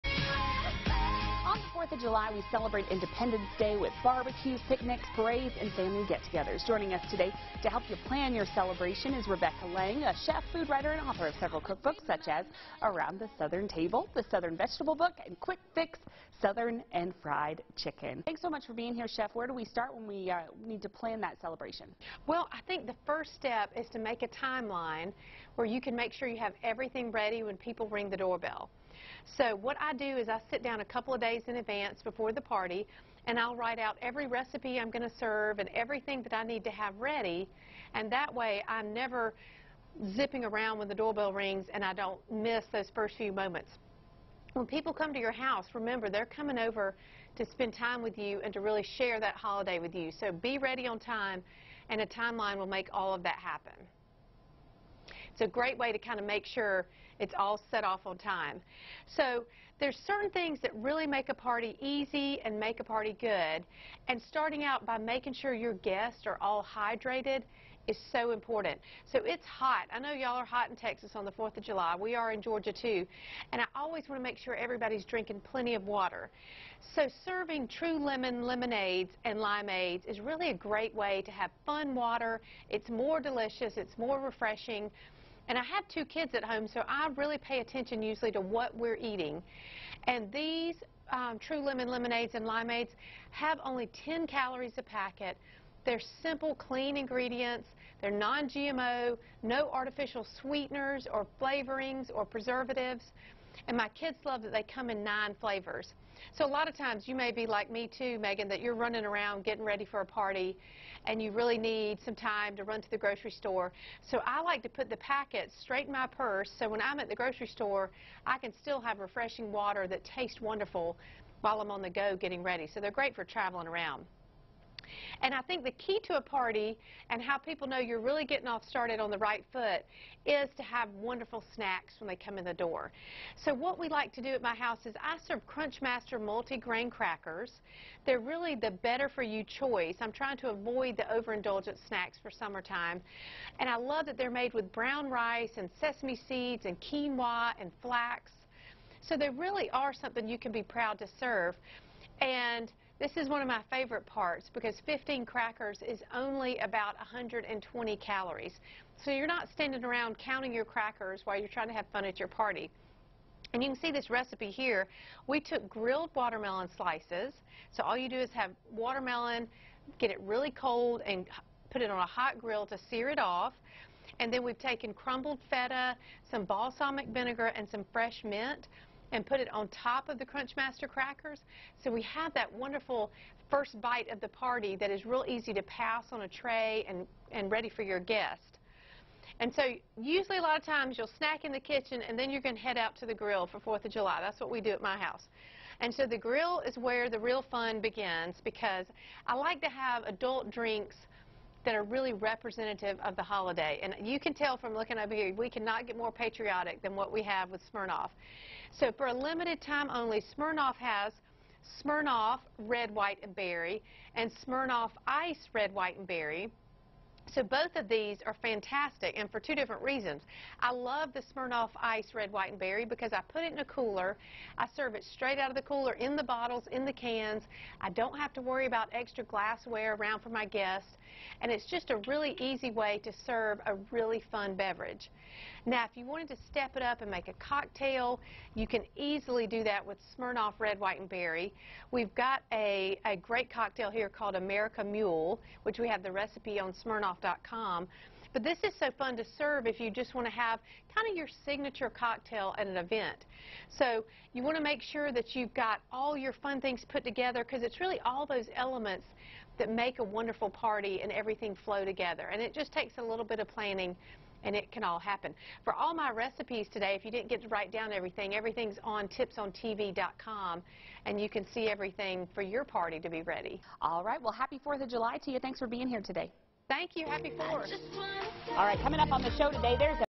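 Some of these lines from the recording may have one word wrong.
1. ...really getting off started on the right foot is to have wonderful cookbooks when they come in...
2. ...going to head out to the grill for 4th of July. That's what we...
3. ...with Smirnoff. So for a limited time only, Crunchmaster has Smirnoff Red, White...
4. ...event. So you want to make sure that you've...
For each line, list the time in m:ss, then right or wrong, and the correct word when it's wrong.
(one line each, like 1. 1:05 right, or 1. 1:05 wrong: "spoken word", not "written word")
1. 2:07 wrong: "snacks", not "cookbooks"
2. 3:12 right
3. 3:27 wrong: "Smirnoff", not "Crunchmaster"
4. 4:12 right.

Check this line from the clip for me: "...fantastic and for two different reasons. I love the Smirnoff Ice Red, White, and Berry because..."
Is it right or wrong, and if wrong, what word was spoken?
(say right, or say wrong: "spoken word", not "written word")
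right.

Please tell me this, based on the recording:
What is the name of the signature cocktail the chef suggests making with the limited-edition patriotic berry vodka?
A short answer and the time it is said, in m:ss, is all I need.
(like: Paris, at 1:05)
America Mule, at 4:04.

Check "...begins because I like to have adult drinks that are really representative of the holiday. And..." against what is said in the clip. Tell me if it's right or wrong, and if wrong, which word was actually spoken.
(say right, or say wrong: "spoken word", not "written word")
right.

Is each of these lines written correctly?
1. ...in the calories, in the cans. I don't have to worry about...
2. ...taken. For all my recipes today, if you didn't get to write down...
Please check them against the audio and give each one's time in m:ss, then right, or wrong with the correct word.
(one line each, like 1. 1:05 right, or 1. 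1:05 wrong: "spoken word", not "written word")
1. 3:45 wrong: "bottles", not "calories"
2. 4:24 wrong: "happen", not "taken".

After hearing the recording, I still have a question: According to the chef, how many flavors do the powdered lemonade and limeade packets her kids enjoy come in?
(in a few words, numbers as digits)
9.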